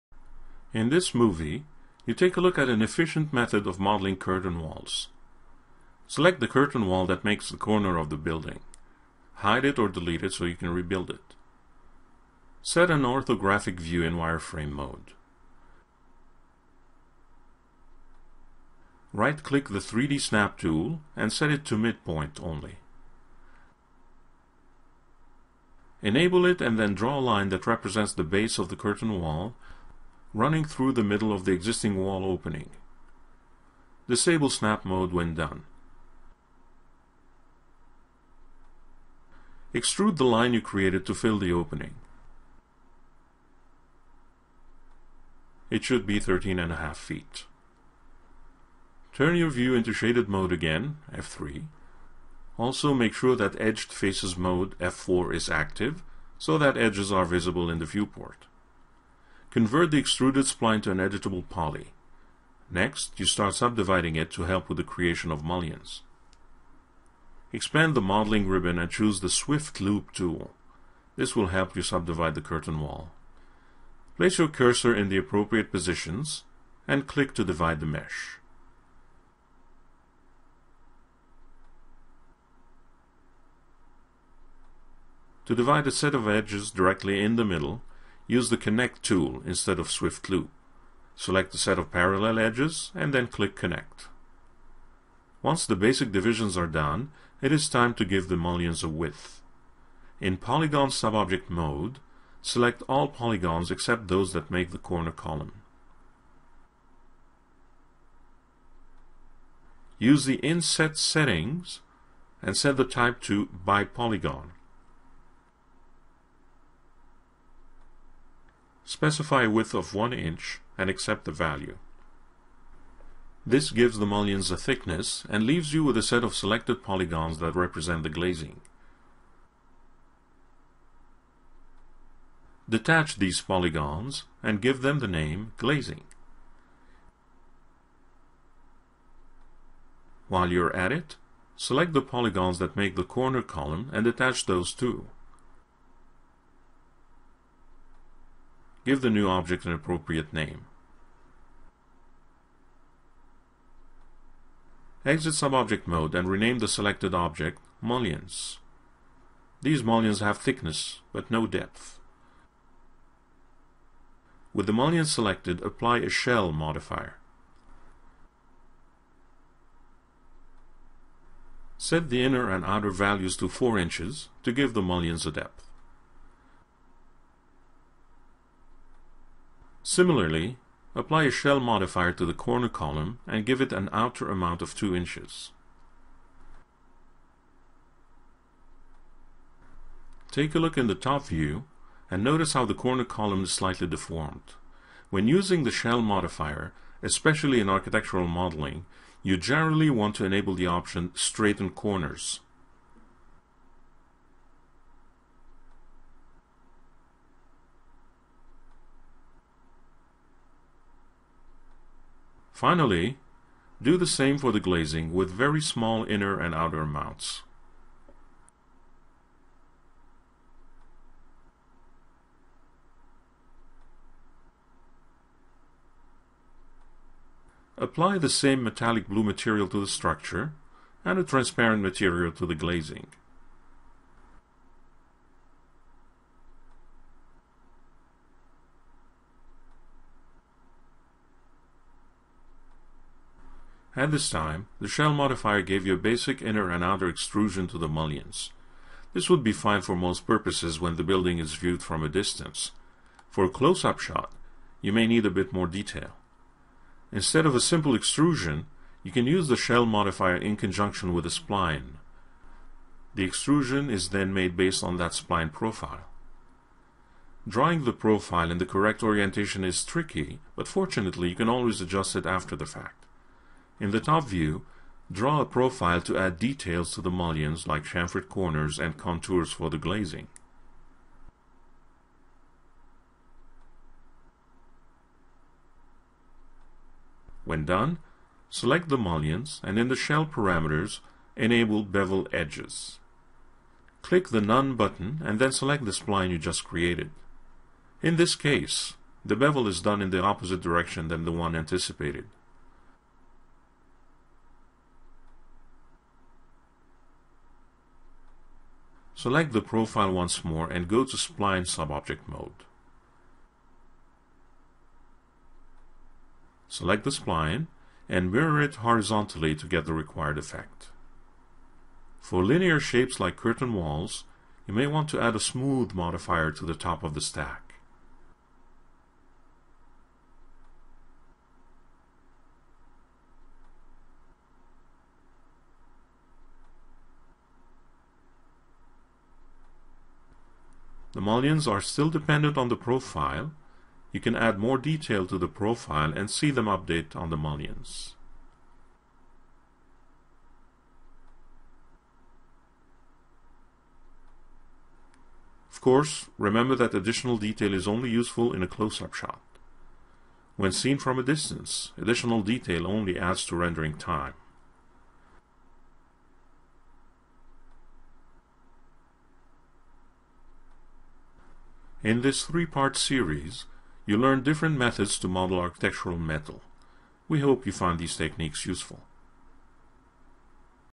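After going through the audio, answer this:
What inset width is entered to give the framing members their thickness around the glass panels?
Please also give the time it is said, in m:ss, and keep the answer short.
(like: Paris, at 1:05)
1 inch, at 1:59.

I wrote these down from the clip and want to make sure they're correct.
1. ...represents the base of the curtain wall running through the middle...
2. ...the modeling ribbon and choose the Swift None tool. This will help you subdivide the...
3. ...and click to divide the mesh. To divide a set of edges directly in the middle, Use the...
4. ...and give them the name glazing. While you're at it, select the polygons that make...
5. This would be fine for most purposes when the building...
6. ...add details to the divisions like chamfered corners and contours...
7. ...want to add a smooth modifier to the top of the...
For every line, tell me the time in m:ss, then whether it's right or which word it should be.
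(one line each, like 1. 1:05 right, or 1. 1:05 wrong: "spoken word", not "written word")
1. 0:27 right
2. 1:07 wrong: "Loop", not "None"
3. 1:16 right
4. 2:14 right
5. 4:09 right
6. 4:36 wrong: "mullions", not "divisions"
7. 5:24 right.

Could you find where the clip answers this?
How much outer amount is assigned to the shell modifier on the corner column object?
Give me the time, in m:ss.
3:04.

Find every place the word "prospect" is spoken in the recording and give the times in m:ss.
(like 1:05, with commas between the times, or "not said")
not said.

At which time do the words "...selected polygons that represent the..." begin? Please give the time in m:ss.
2:06.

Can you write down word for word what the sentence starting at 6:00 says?
When seen from a distance, additional detail only adds to rendering time.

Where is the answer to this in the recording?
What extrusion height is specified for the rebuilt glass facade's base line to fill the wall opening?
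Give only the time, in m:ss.
0:46.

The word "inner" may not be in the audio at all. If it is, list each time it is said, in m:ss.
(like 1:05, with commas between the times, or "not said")
2:52, 3:36, 4:06.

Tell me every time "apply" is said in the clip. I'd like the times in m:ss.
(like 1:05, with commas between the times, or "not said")
2:45, 3:00, 3:47.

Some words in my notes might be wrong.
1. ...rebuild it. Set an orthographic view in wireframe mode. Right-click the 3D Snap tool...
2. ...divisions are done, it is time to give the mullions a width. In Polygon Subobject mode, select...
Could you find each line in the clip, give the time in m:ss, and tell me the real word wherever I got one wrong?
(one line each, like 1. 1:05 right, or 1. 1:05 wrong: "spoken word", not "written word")
1. 0:10 right
2. 1:36 right.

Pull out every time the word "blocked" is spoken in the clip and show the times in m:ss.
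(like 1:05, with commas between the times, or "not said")
not said.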